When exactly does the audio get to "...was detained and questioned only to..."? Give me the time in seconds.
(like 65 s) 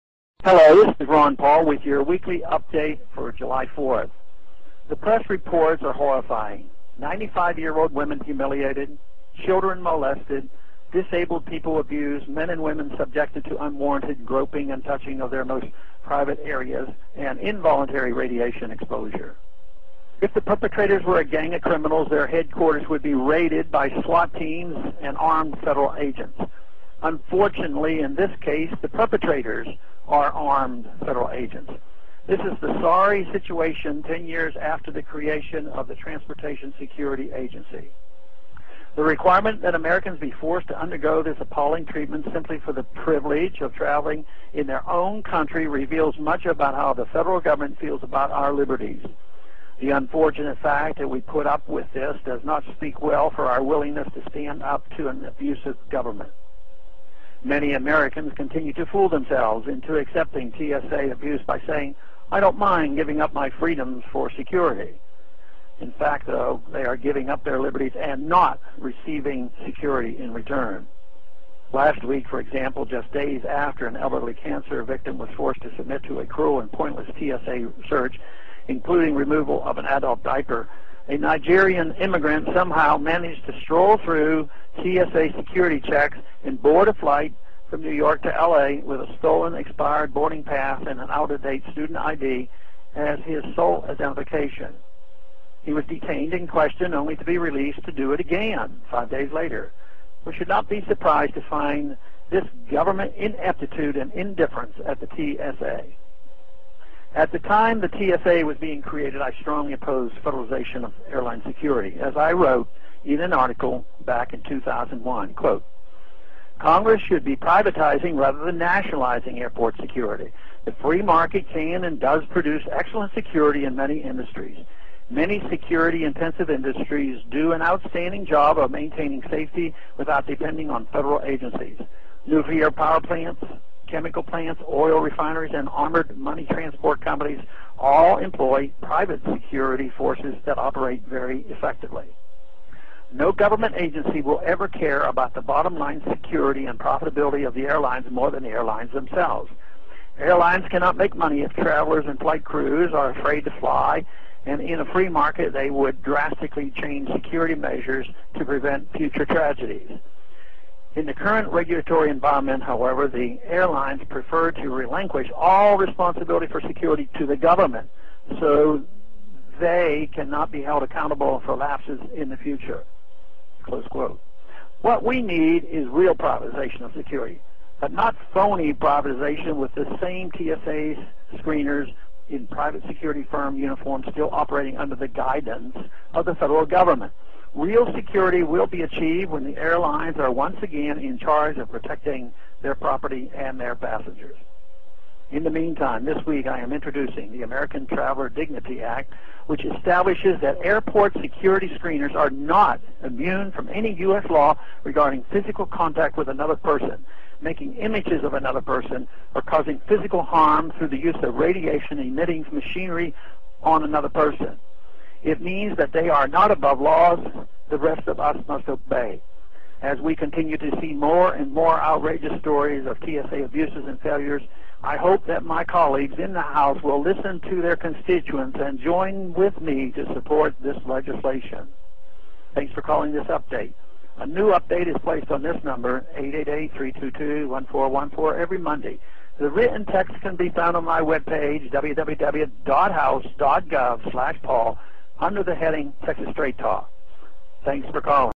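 95 s.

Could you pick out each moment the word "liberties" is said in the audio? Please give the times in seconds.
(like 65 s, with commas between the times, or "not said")
48 s, 67 s.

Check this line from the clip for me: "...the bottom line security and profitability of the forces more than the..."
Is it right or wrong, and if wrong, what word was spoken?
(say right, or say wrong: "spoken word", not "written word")
wrong: "airlines", not "forces".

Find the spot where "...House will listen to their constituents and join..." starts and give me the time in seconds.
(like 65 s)
226 s.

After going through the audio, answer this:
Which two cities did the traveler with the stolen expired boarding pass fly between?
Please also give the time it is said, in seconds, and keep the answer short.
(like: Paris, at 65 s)
New York to LA, at 87 s.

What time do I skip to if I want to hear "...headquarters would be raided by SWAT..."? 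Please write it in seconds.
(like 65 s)
22 s.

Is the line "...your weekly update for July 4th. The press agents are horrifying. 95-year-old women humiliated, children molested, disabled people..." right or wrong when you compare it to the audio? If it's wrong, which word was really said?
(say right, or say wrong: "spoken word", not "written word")
wrong: "reports", not "agents".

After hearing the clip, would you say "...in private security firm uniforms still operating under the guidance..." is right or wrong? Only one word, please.
right.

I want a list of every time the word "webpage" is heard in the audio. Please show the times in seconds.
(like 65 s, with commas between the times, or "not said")
241 s.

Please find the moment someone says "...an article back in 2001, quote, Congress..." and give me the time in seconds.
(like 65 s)
113 s.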